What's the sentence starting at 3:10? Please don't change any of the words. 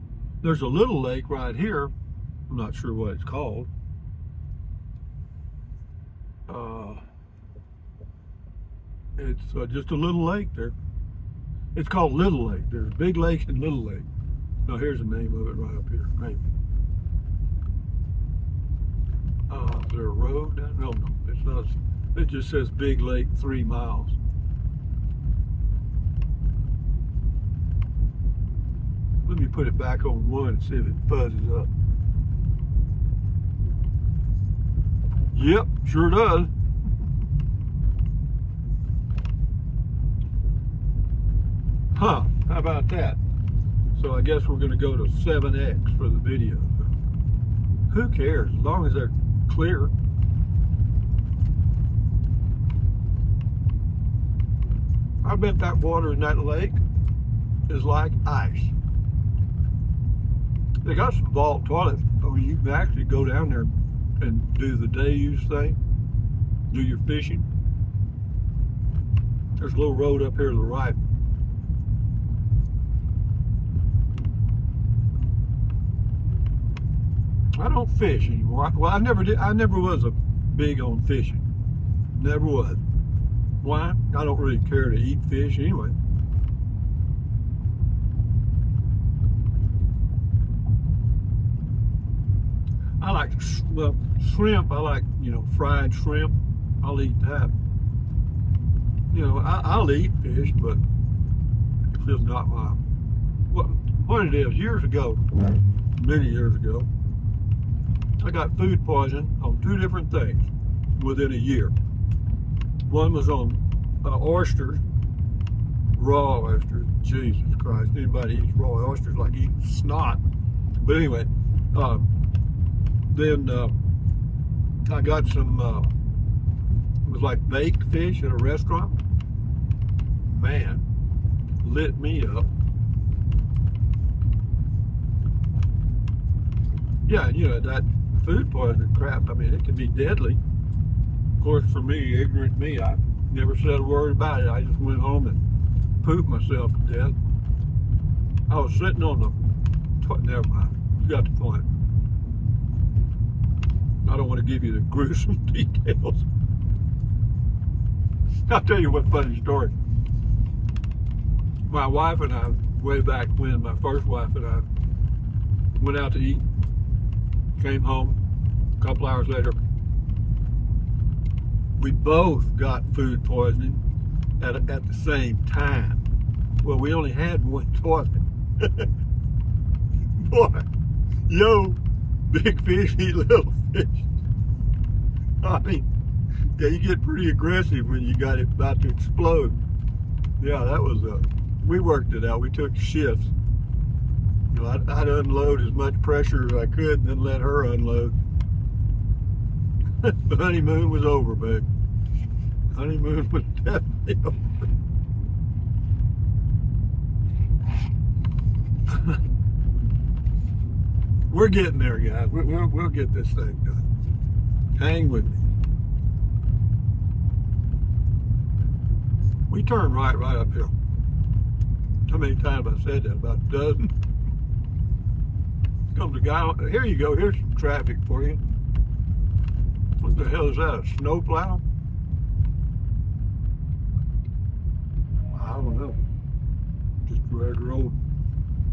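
Yeah, that was a, uh, we worked it out.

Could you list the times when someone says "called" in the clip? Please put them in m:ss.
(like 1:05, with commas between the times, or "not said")
0:03, 0:11.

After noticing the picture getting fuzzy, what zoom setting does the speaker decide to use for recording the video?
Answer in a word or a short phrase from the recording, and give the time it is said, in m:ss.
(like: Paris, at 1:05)
7X, at 0:45.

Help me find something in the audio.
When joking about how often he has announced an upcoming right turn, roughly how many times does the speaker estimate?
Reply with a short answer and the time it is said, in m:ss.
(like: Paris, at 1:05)
About a dozen, at 3:43.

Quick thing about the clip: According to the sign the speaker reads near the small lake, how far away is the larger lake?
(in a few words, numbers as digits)
3 miles.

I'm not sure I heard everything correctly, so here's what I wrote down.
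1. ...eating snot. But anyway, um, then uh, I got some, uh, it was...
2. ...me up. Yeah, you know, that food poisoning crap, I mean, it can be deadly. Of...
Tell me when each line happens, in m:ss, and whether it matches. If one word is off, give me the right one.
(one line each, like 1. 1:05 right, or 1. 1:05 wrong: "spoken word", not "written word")
1. 1:59 right
2. 2:11 right.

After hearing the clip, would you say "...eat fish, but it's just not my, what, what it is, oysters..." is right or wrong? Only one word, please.
wrong.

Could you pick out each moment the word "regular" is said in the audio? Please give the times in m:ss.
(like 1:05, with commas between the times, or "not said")
3:57.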